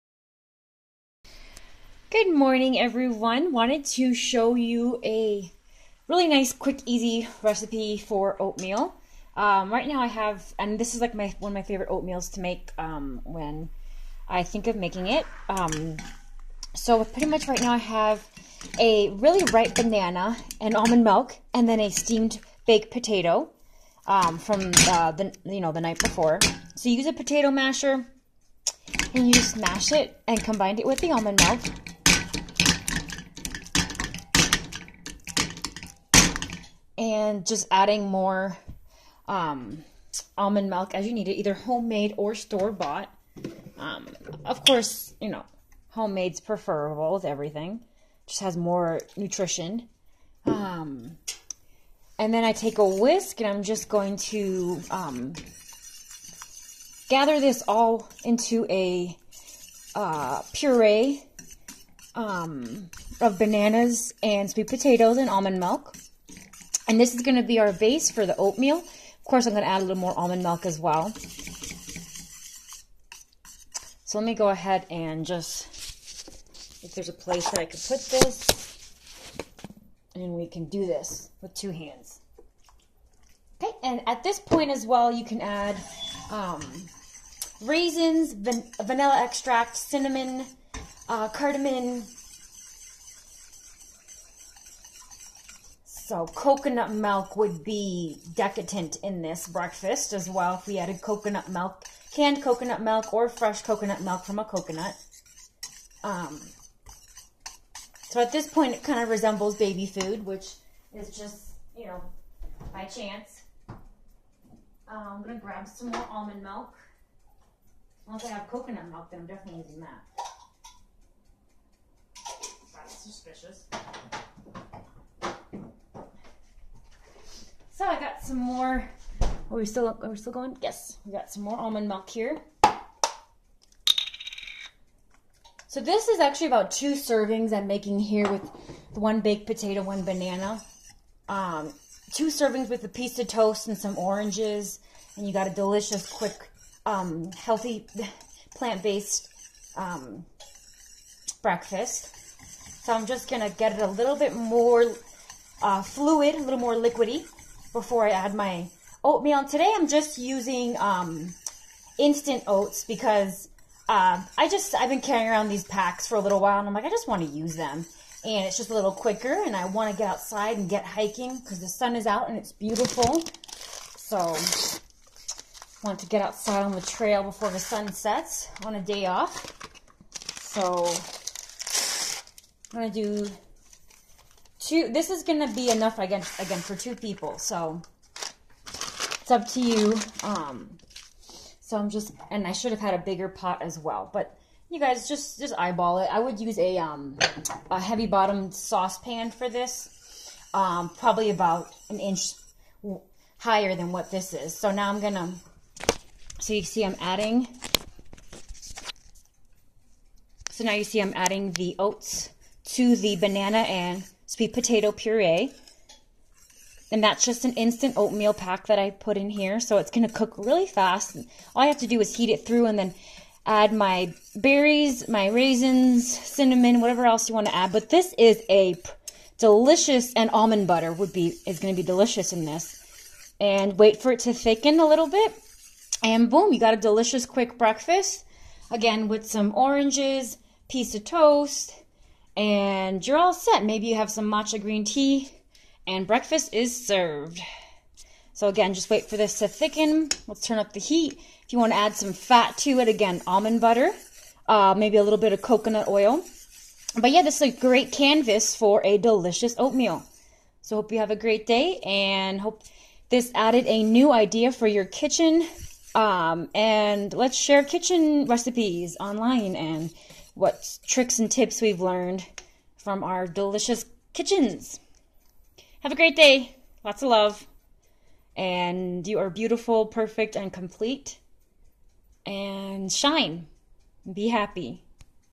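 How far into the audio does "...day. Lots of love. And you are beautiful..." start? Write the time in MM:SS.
04:36.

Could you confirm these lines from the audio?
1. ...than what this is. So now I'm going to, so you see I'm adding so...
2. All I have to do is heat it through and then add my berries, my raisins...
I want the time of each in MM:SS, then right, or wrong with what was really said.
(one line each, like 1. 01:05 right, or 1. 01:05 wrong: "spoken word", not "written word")
1. 03:23 right
2. 03:41 right.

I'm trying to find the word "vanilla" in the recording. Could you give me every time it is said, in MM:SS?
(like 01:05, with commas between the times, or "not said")
01:28.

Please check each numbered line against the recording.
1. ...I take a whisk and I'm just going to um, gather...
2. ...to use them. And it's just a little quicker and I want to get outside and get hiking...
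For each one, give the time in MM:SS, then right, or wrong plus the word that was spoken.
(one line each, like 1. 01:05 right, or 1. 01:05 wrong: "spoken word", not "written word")
1. 00:52 right
2. 02:47 right.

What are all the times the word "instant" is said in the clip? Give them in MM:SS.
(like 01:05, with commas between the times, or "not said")
02:41, 03:37.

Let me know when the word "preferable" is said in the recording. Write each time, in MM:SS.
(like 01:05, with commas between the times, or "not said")
00:46.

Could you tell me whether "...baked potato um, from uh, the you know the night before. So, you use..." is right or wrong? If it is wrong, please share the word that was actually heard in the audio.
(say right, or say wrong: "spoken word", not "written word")
right.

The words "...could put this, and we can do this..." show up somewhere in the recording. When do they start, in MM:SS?
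01:17.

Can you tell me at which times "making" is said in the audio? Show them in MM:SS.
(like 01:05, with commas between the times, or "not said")
00:14, 02:17.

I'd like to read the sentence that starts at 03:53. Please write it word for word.
And wait for it to thicken a little bit.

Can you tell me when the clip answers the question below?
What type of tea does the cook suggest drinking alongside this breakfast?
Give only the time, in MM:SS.
04:04.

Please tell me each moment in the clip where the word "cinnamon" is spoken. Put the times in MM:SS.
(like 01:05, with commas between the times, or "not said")
01:29, 03:46.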